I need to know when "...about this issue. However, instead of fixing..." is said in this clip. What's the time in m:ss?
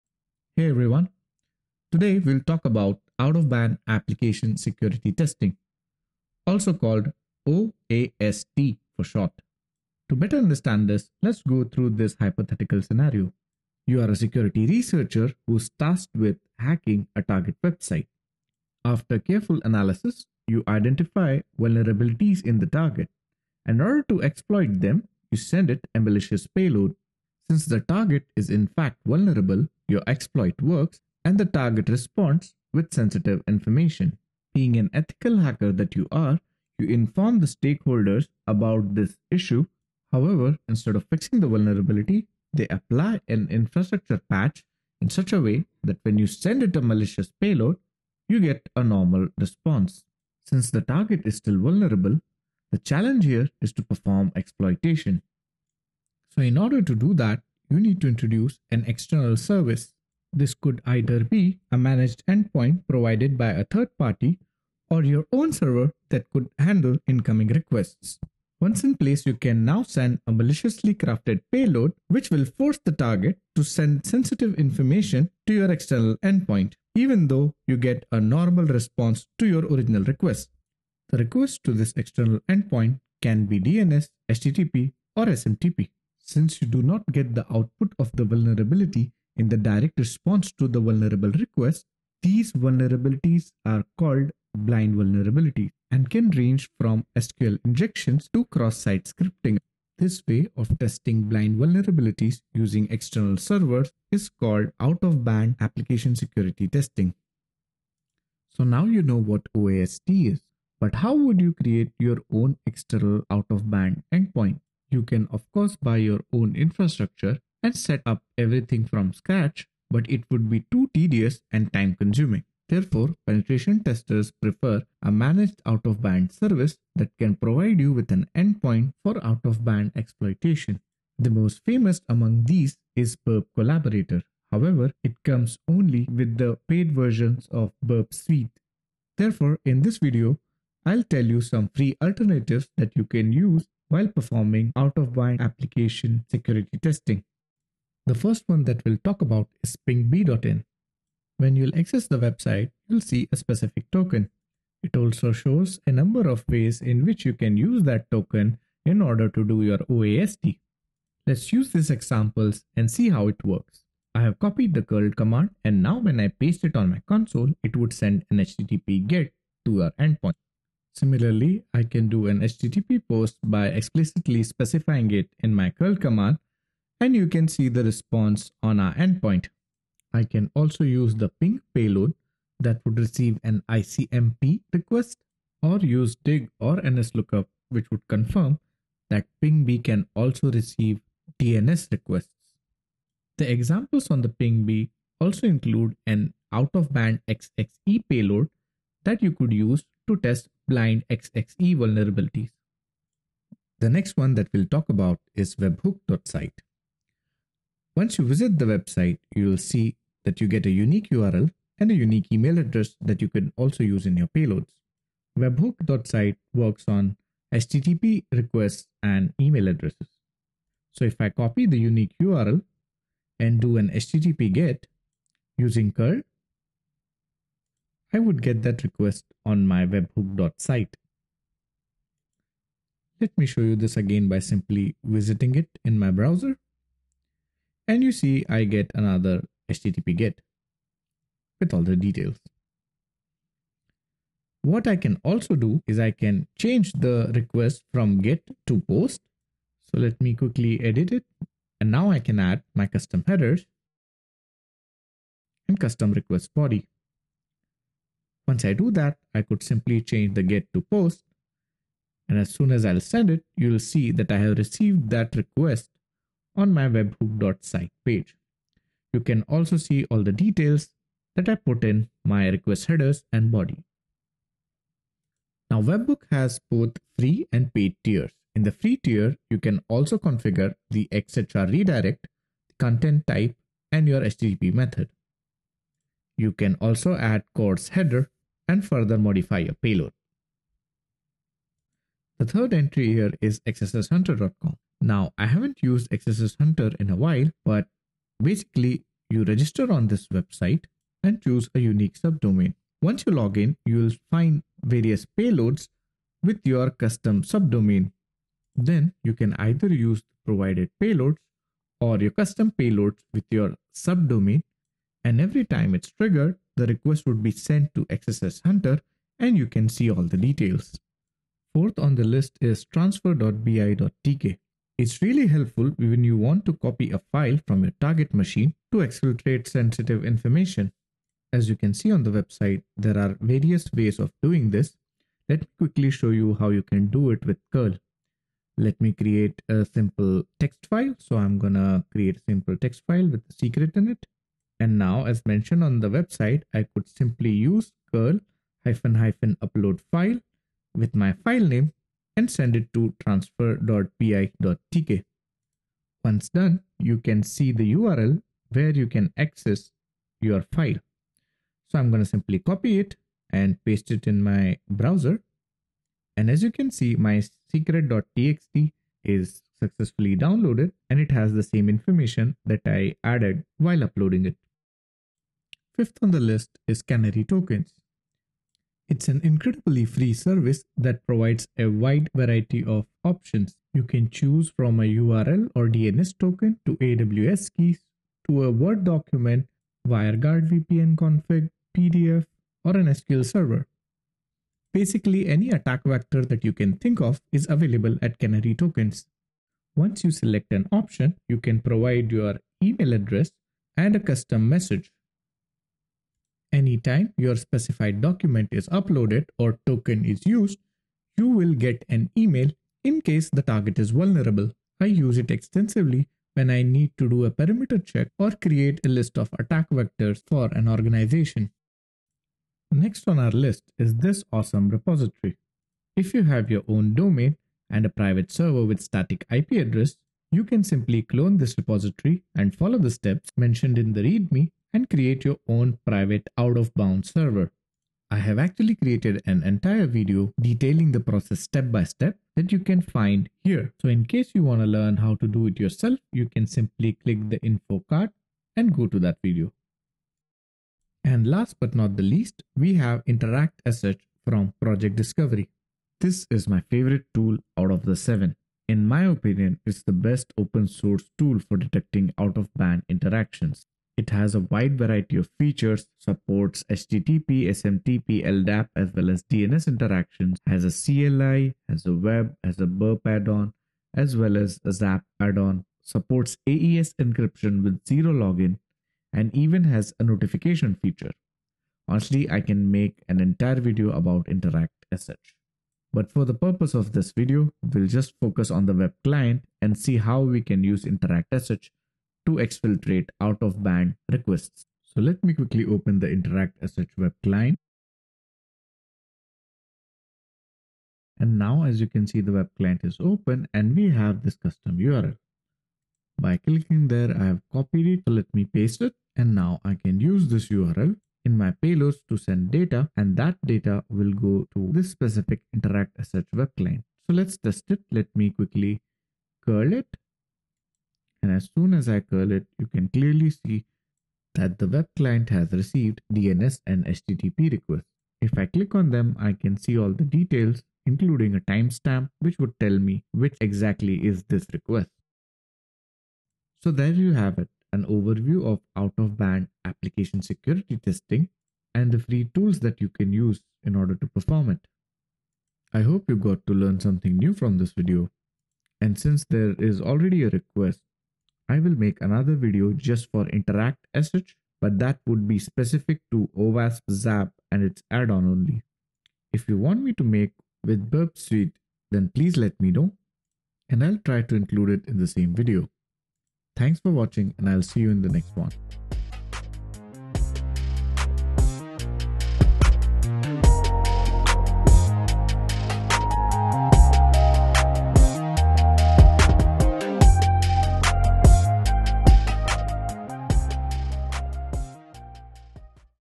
0:38.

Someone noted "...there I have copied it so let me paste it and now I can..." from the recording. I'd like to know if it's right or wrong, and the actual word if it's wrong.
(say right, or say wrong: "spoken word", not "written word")
right.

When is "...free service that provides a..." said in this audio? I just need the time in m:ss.
6:20.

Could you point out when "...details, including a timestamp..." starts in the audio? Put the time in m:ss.
8:50.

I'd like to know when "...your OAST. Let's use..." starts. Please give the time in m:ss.
2:39.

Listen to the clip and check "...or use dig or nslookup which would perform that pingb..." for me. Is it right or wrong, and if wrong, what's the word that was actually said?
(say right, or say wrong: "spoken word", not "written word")
wrong: "confirm", not "perform".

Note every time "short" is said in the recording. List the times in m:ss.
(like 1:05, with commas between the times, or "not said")
0:09.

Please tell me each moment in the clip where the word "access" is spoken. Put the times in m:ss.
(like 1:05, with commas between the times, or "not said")
2:31, 5:59.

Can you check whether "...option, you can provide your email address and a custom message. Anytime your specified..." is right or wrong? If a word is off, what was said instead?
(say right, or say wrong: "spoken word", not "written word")
right.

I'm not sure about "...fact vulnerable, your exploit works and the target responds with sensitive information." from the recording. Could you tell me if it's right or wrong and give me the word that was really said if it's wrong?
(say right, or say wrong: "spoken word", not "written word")
right.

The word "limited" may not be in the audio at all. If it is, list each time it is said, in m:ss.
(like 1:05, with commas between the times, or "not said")
not said.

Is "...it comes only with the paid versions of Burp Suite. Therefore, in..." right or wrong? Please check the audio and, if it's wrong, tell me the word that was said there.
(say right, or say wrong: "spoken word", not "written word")
right.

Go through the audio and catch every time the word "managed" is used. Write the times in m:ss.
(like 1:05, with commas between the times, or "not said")
1:01, 2:05.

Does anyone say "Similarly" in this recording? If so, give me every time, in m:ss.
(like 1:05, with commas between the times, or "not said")
2:50.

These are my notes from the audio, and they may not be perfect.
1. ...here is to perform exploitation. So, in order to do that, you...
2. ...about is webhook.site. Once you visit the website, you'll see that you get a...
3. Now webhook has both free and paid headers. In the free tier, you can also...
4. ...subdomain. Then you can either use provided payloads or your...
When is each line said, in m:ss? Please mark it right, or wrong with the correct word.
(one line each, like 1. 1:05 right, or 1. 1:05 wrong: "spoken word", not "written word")
1. 0:53 right
2. 3:24 right
3. 4:35 wrong: "tiers", not "headers"
4. 5:07 right.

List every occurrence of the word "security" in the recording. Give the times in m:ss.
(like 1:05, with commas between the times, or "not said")
0:04, 0:14, 1:46, 2:26, 9:00.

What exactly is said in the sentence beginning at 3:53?
Let me show you this again by simply visiting it in my browser.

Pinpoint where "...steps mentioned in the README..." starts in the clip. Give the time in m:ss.
7:13.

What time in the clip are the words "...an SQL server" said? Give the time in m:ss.
6:32.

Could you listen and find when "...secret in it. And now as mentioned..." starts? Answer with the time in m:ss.
5:43.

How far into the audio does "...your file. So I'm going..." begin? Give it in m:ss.
6:00.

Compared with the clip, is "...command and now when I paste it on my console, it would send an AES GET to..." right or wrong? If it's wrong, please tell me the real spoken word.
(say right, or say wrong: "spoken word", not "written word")
wrong: "HTTP", not "AES".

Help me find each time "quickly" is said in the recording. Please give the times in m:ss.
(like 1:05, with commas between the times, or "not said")
4:10, 5:35, 8:15, 8:38.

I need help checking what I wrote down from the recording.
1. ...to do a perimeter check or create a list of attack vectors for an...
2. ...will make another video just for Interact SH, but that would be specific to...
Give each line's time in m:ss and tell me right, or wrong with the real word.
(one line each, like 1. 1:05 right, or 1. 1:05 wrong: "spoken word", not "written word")
1. 6:57 right
2. 9:11 right.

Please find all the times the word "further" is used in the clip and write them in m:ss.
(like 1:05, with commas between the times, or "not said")
4:48.